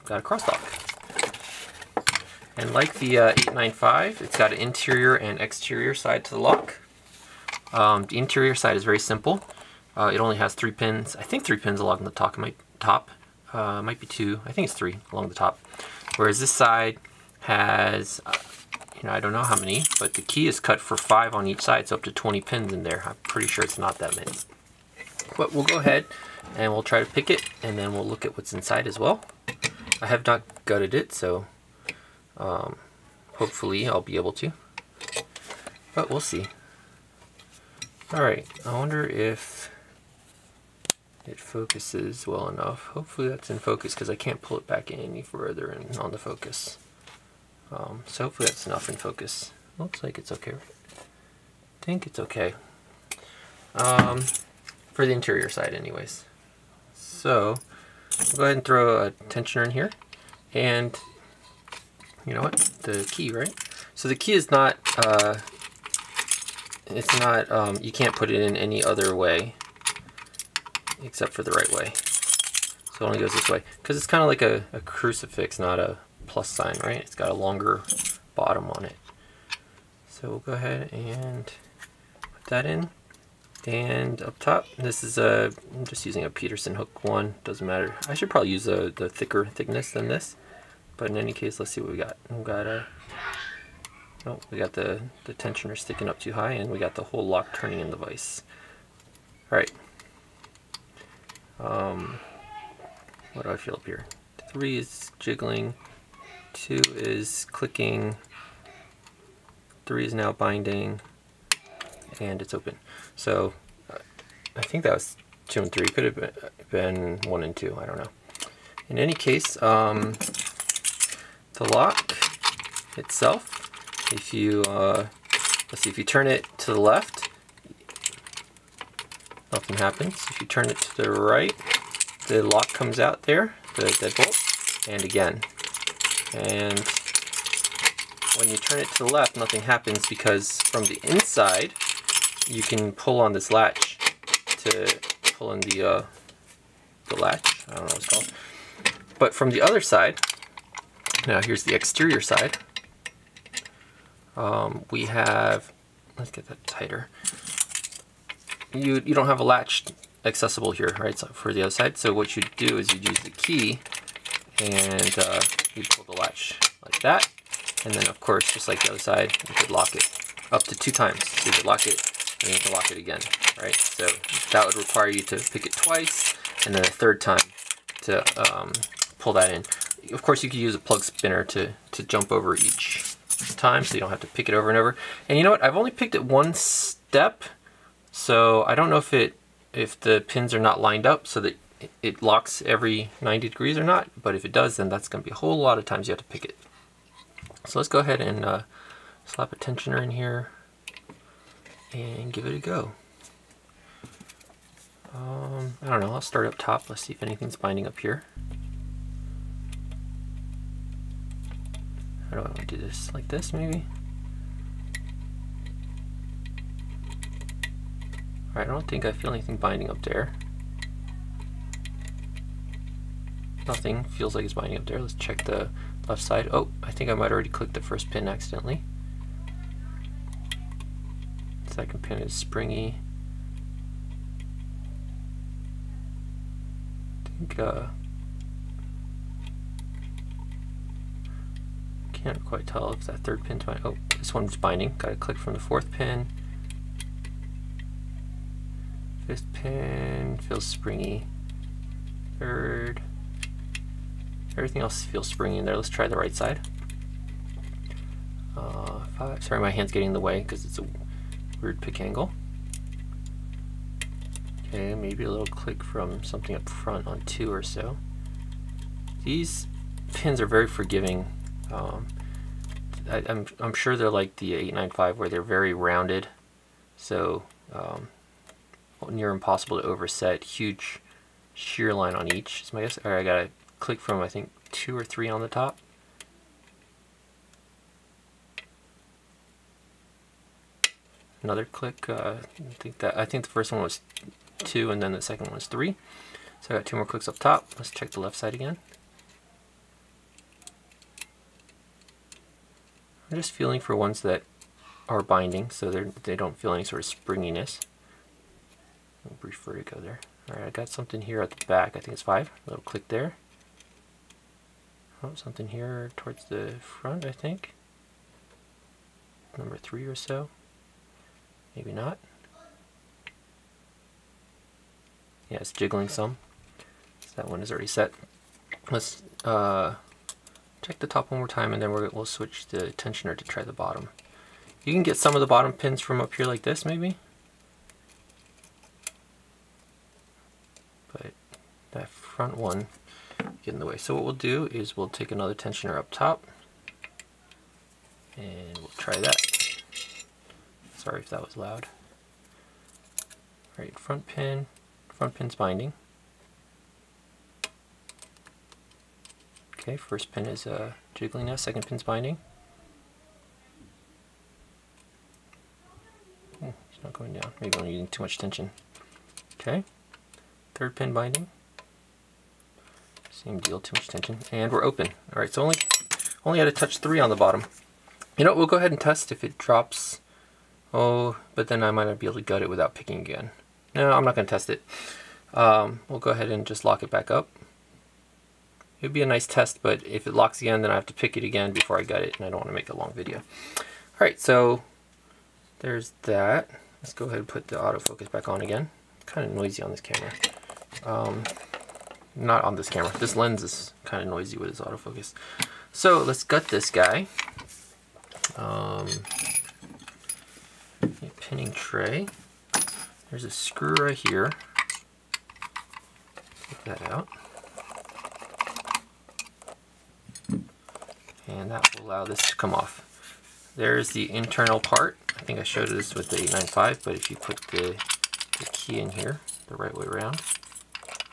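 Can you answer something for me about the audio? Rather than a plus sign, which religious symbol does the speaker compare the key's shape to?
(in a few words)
Crucifix.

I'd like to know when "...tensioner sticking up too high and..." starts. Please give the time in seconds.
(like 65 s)
95 s.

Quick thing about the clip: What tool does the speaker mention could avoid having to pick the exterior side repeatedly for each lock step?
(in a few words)
Plug spinner.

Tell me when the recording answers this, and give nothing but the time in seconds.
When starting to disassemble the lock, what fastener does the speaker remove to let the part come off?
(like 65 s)
413 s.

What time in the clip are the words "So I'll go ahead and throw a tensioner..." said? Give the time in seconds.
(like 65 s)
56 s.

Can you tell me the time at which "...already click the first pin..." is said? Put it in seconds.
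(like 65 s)
227 s.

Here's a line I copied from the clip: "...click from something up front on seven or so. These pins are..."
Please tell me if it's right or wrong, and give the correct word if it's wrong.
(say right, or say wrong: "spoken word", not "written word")
wrong: "two", not "seven".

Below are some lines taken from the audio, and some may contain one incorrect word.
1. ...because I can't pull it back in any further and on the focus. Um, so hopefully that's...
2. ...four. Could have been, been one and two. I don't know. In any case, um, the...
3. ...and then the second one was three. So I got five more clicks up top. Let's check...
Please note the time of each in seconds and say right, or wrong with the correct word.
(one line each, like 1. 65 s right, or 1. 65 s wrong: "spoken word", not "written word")
1. 43 s right
2. 115 s wrong: "three", not "four"
3. 294 s wrong: "two", not "five".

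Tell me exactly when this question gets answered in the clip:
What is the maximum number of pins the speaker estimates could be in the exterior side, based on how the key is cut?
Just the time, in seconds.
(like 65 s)
22 s.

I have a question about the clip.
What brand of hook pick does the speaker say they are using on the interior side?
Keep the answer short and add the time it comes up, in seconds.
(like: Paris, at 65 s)
Peterson, at 86 s.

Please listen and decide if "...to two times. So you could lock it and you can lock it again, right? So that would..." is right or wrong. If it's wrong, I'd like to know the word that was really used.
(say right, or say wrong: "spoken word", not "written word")
right.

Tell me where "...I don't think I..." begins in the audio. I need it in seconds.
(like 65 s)
218 s.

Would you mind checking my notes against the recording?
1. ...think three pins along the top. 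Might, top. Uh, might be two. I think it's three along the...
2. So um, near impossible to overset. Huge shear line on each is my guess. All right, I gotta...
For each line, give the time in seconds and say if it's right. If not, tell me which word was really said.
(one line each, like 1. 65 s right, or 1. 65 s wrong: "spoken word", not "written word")
1. 11 s right
2. 276 s right.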